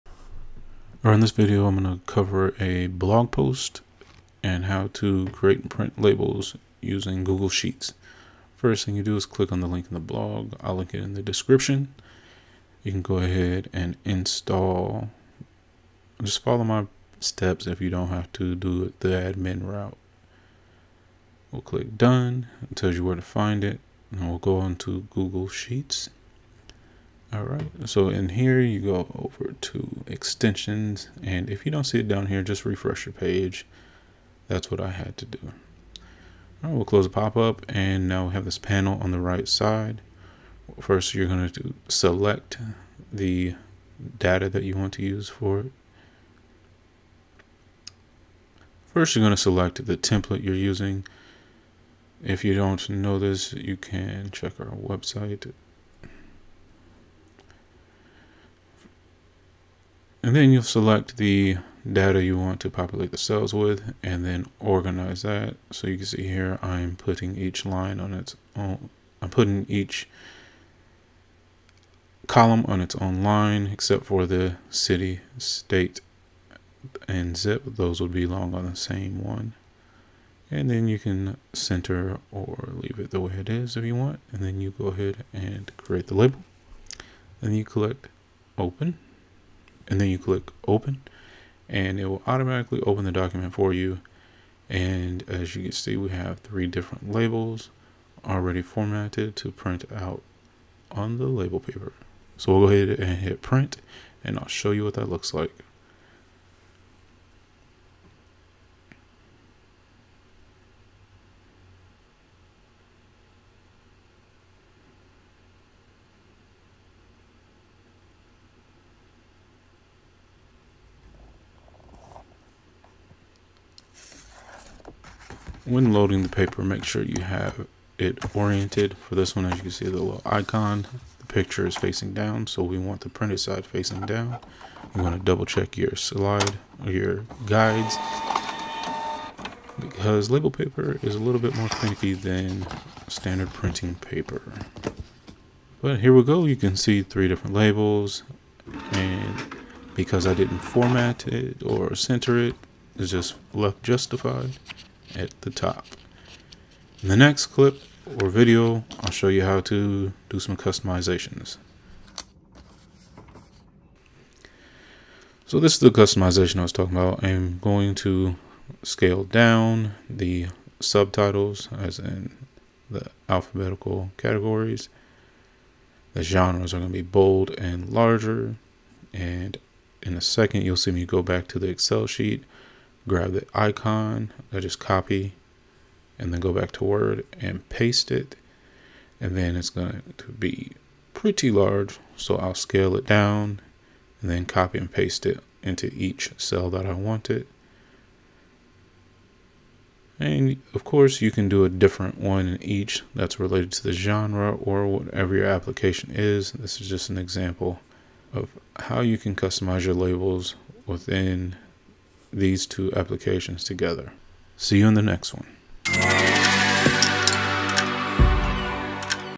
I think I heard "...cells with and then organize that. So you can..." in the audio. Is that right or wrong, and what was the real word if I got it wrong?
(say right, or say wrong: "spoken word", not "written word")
right.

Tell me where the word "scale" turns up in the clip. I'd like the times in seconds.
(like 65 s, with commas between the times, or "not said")
168 s, 192 s.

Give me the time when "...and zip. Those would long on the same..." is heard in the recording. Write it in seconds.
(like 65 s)
77 s.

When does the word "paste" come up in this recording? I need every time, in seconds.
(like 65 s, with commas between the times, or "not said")
187 s, 194 s.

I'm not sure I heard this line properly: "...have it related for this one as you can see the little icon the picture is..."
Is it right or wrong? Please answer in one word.
wrong.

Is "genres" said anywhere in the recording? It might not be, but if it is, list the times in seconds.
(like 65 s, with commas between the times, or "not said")
176 s, 203 s.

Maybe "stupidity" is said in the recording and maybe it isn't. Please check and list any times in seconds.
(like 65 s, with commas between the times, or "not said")
not said.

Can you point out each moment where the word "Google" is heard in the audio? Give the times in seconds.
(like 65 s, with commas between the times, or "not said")
7 s, 25 s.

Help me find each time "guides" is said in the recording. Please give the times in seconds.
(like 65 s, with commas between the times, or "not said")
137 s.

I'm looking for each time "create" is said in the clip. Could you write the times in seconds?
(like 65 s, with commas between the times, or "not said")
5 s, 85 s.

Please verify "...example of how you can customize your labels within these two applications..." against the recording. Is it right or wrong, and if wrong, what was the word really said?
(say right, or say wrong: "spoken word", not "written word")
right.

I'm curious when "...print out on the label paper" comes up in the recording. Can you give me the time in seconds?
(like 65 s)
99 s.